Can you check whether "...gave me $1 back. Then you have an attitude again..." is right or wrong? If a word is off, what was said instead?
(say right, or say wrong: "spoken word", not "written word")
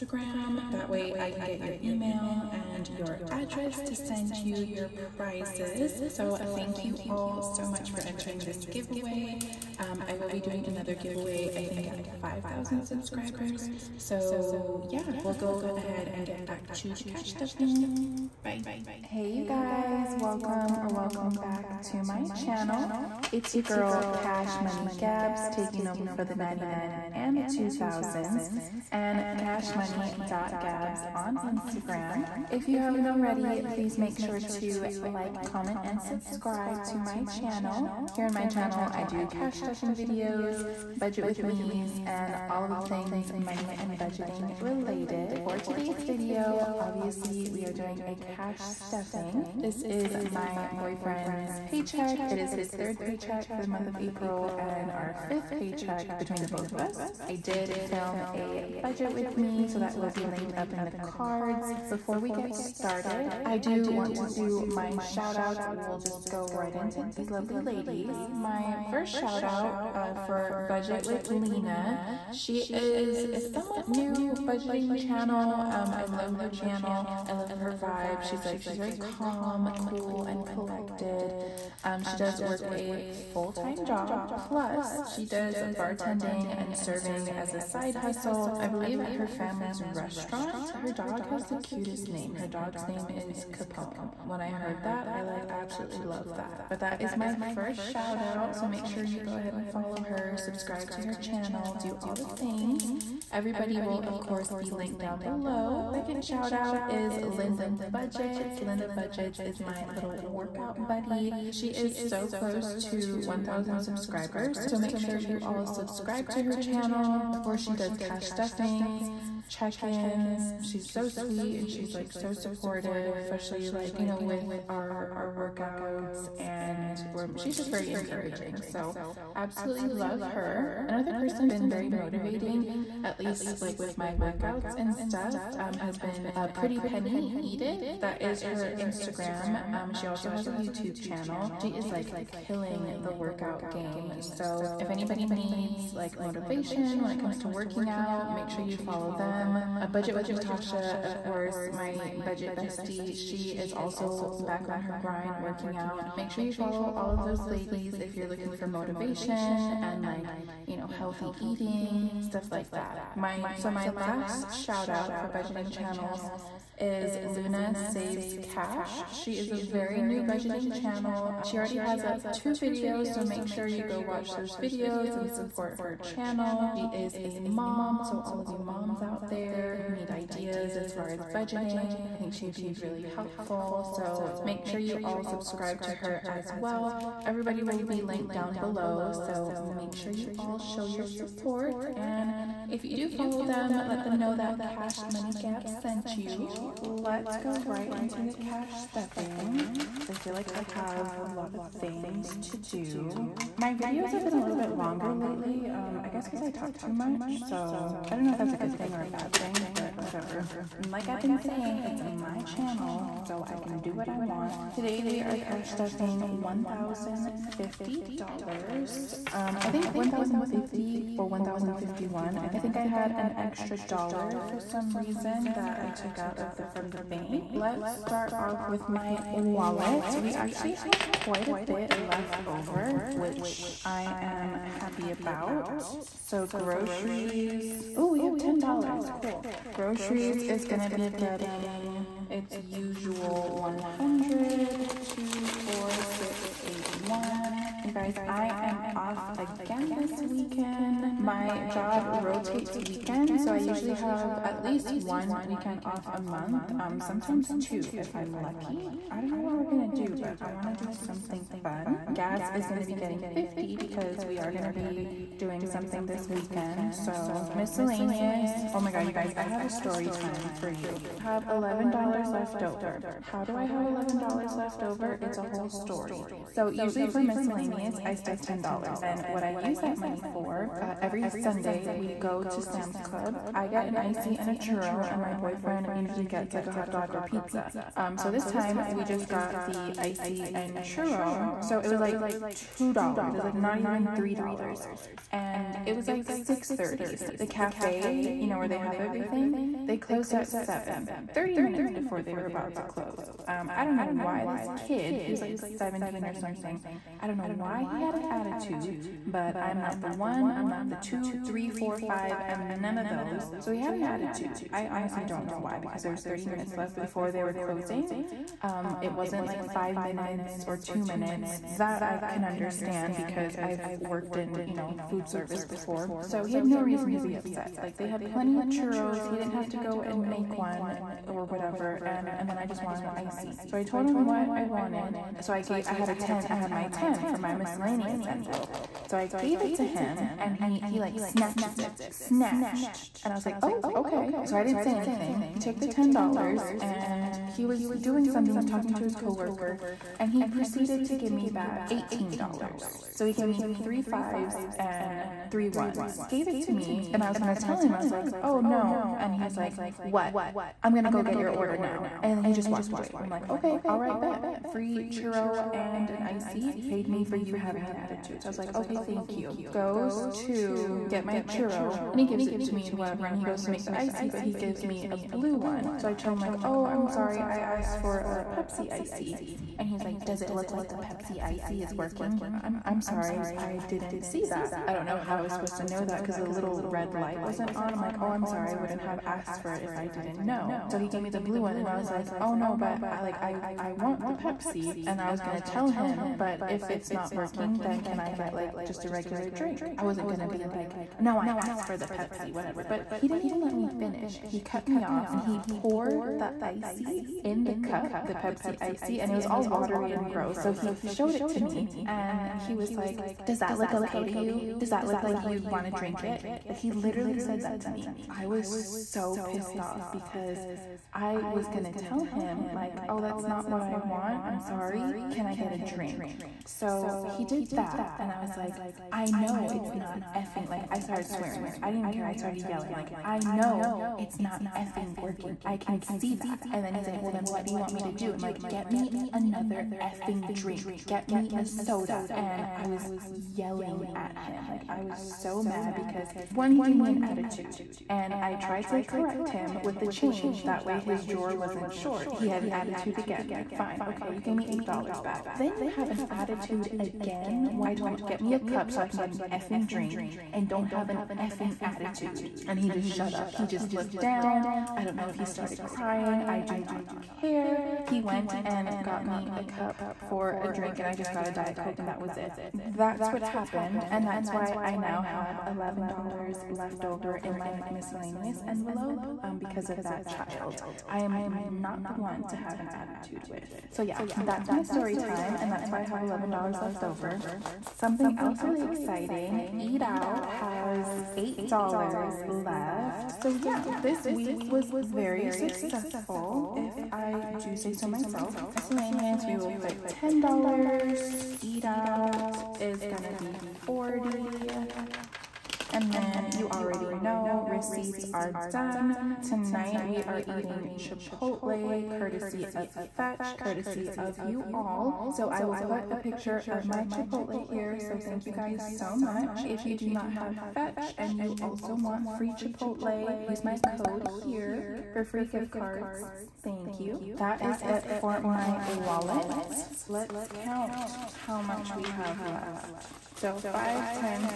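wrong: "8", not "1".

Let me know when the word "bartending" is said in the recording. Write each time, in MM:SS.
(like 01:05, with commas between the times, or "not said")
01:25.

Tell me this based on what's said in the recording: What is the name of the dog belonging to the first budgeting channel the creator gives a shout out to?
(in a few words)
Capone.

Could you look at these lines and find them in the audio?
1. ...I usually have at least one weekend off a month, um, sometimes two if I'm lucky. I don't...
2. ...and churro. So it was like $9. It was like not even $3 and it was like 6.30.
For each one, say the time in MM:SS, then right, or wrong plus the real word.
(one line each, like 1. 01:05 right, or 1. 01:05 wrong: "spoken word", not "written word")
1. 04:13 right
2. 04:50 wrong: "2", not "9".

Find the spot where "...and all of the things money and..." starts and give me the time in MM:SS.
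00:42.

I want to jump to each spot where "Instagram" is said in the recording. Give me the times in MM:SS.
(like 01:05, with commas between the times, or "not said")
00:31, 02:18.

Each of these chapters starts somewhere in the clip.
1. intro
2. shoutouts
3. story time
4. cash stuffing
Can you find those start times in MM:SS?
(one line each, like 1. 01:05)
1. 00:19
2. 01:08
3. 04:29
4. 08:07.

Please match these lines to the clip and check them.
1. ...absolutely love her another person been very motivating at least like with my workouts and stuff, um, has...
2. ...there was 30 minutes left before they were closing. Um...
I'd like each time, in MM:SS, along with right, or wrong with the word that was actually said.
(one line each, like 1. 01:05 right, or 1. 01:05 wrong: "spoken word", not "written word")
1. 02:09 right
2. 05:16 right.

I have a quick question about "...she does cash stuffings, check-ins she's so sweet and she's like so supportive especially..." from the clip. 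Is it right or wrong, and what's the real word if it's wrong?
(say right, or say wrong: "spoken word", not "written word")
right.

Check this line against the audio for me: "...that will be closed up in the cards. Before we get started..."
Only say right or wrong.
wrong.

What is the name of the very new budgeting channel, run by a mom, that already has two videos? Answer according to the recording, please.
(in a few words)
Luna Saves Cash.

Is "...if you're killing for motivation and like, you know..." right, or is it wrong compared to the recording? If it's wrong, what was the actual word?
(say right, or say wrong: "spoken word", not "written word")
wrong: "looking", not "killing".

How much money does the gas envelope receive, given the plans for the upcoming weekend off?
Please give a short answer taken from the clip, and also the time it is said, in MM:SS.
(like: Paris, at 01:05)
$50, at 04:23.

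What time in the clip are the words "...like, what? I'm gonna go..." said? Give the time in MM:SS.
05:59.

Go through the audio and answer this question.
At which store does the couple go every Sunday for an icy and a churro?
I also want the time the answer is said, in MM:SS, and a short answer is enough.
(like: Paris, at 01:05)
Sam's Club, at 04:42.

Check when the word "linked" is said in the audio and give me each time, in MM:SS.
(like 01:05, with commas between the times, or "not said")
01:00, 01:44, 03:08.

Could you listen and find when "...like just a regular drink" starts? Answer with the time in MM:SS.
06:38.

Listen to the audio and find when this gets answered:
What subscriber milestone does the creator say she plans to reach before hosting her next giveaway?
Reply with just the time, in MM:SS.
00:12.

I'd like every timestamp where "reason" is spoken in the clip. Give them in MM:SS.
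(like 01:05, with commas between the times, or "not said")
03:44, 05:26.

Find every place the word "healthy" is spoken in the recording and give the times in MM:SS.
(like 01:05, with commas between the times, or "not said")
02:40.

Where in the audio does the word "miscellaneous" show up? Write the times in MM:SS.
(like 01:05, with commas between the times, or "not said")
04:27, 04:37, 05:37, 07:57, 08:18.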